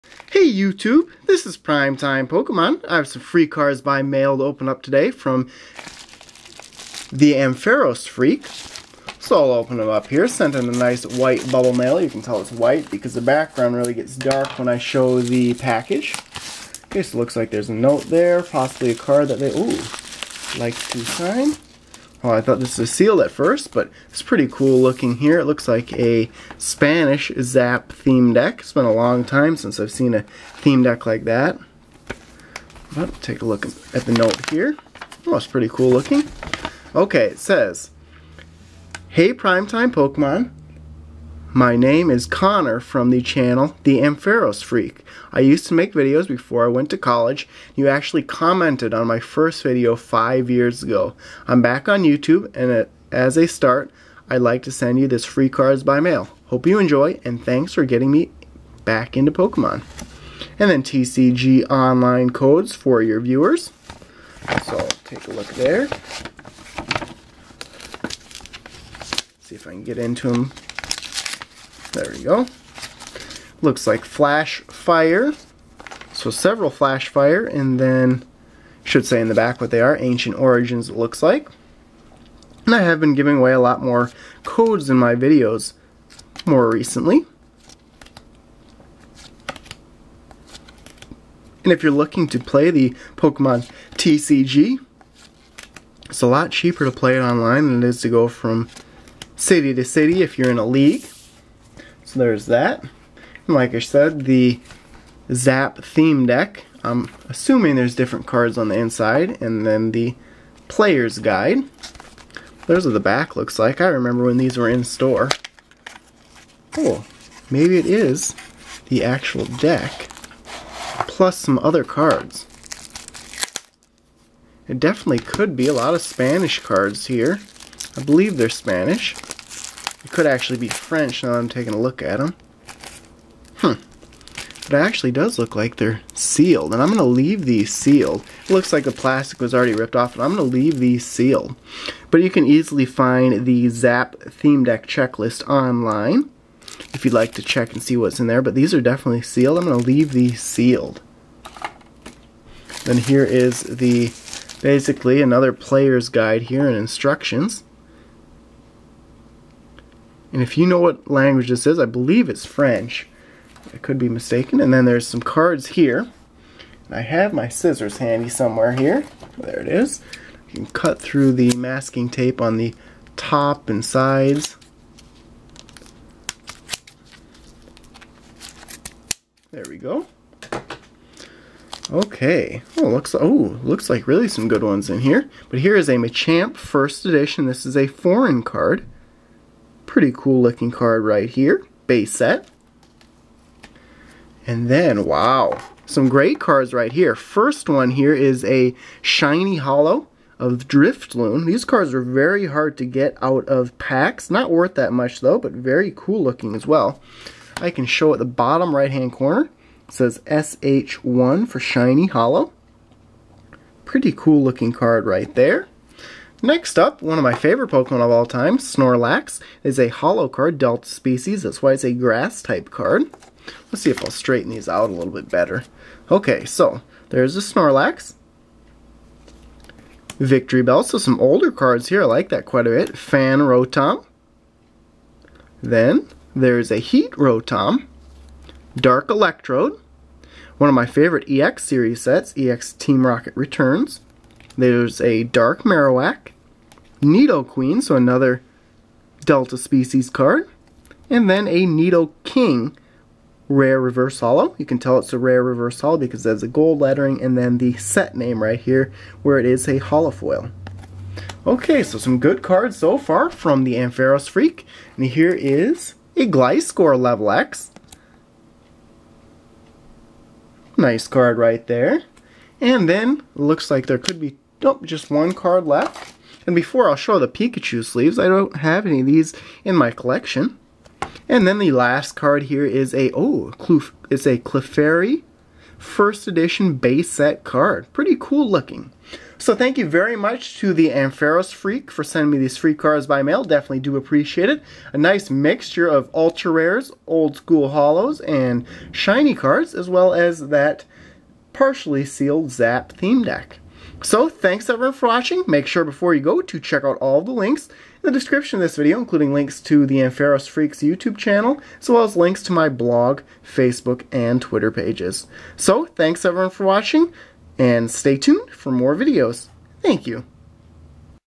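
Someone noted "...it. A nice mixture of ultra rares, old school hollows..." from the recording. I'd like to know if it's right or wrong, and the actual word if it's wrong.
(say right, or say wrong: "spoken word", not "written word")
right.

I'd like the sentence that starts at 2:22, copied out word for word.
But you can easily find the Zap Theme Deck Checklist online if you'd like to check and see what's in there.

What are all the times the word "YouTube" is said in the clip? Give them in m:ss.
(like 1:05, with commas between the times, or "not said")
0:00, 0:52, 5:10.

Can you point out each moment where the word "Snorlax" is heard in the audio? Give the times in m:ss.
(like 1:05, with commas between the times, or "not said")
3:38, 3:47.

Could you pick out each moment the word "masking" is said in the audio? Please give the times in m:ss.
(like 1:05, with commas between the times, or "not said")
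2:51.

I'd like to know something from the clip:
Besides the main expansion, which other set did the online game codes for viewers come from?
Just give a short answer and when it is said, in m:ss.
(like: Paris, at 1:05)
Ancient Origins, at 1:19.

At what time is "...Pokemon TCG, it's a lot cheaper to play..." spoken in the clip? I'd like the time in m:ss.
1:33.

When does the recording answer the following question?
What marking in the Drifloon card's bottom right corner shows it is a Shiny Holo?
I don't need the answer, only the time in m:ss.
3:30.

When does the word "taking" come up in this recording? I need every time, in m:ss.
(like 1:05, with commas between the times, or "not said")
2:11.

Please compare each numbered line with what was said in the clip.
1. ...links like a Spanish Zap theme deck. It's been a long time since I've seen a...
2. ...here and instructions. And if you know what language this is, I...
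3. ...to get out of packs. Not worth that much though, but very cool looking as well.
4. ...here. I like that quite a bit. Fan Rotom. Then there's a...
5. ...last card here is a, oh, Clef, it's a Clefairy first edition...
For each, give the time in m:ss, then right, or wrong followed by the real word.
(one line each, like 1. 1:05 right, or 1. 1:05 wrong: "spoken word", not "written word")
1. 0:25 wrong: "looks", not "links"
2. 2:36 right
3. 3:22 right
4. 3:51 right
5. 4:41 right.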